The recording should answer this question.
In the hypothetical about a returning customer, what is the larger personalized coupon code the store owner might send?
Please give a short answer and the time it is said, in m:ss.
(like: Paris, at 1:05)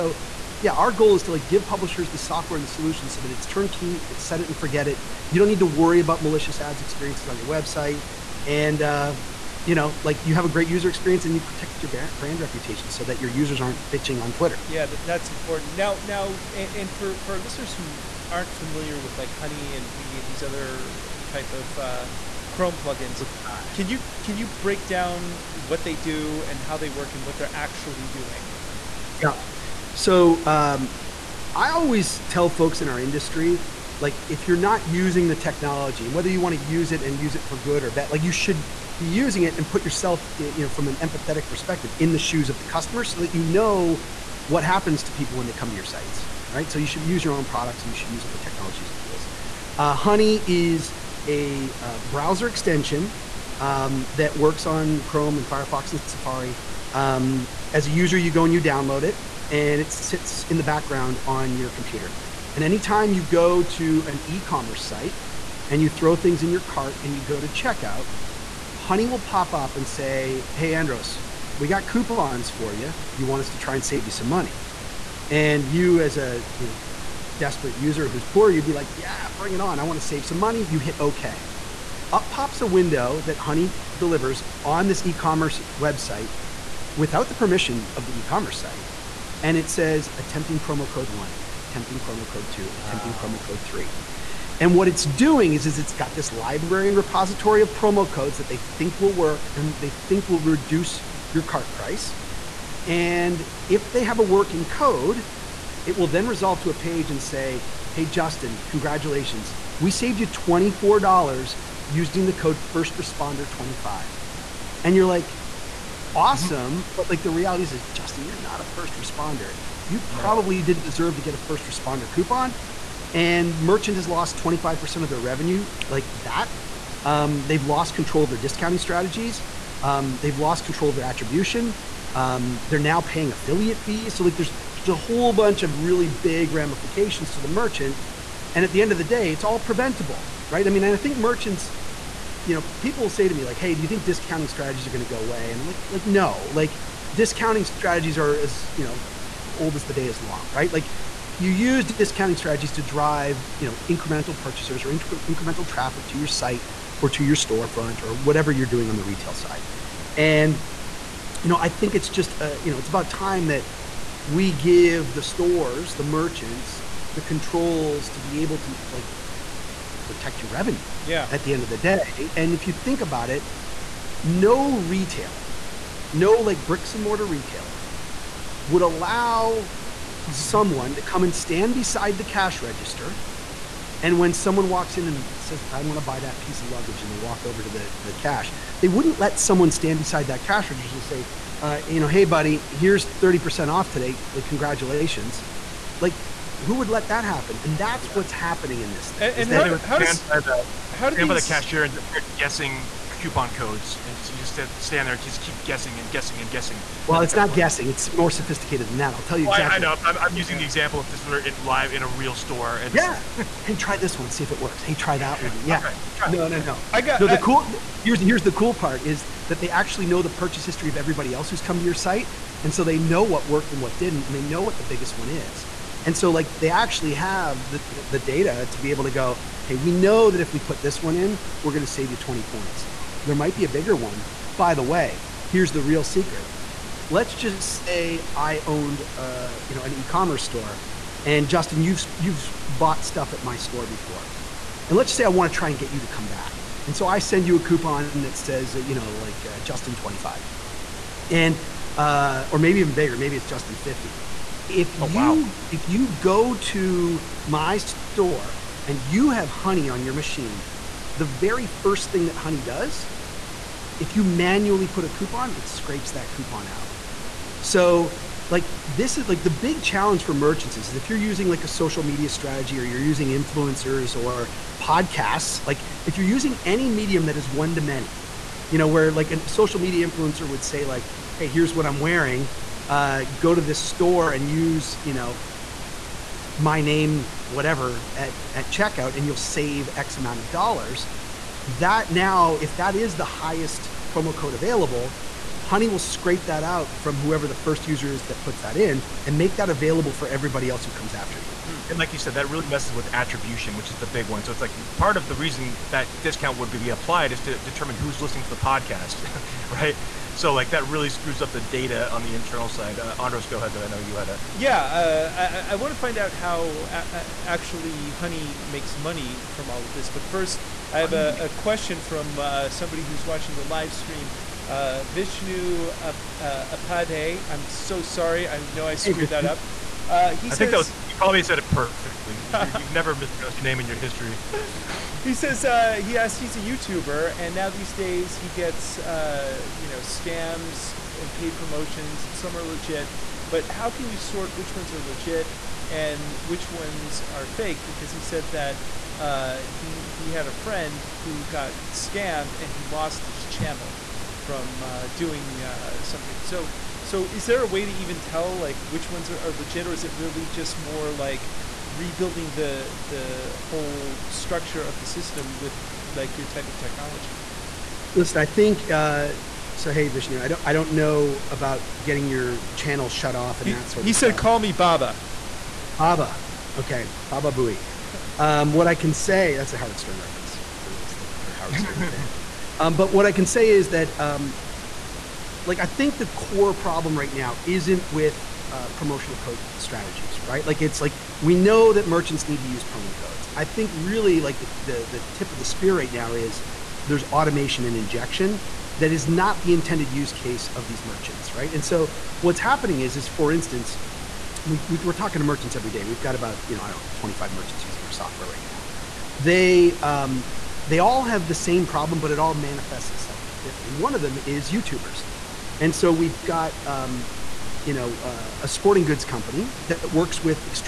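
Justin 50, at 4:13.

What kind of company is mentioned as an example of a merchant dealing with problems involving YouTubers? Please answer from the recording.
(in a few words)
sporting goods company.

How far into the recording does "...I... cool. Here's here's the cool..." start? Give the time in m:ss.
3:37.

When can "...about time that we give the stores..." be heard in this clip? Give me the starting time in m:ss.
2:42.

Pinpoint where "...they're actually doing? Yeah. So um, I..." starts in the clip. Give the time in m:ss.
0:27.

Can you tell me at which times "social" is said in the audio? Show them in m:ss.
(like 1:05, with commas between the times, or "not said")
4:31, 4:39.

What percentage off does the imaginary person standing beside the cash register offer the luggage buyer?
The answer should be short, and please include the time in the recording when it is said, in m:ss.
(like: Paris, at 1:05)
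30%, at 3:13.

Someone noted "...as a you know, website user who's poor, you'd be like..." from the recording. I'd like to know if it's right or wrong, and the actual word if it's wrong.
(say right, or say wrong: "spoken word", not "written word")
wrong: "desperate", not "website".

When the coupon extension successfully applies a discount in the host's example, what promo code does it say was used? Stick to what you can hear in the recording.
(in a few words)
first responder 25.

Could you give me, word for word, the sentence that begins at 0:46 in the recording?
So you should use your own products and you should use all the technologies and tools.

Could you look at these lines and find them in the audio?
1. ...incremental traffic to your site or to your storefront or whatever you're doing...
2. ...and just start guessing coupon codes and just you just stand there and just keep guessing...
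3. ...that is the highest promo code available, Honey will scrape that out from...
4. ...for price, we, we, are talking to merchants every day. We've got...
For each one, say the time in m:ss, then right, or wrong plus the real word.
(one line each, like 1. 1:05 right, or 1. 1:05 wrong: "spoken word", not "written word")
1. 2:35 right
2. 3:21 right
3. 4:52 right
4. 6:43 wrong: "instance", not "price".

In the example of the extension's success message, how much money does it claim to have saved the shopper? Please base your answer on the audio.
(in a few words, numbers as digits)
$24.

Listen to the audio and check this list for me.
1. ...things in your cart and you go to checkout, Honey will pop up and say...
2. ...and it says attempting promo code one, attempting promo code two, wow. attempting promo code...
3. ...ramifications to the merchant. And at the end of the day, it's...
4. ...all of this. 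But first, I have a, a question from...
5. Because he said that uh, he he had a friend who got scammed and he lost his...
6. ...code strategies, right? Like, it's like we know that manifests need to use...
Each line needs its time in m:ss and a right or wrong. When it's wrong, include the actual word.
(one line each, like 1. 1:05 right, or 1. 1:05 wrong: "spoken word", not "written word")
1. 1:06 right
2. 1:29 right
3. 2:16 right
4. 5:19 right
5. 5:47 right
6. 6:29 wrong: "merchants", not "manifests".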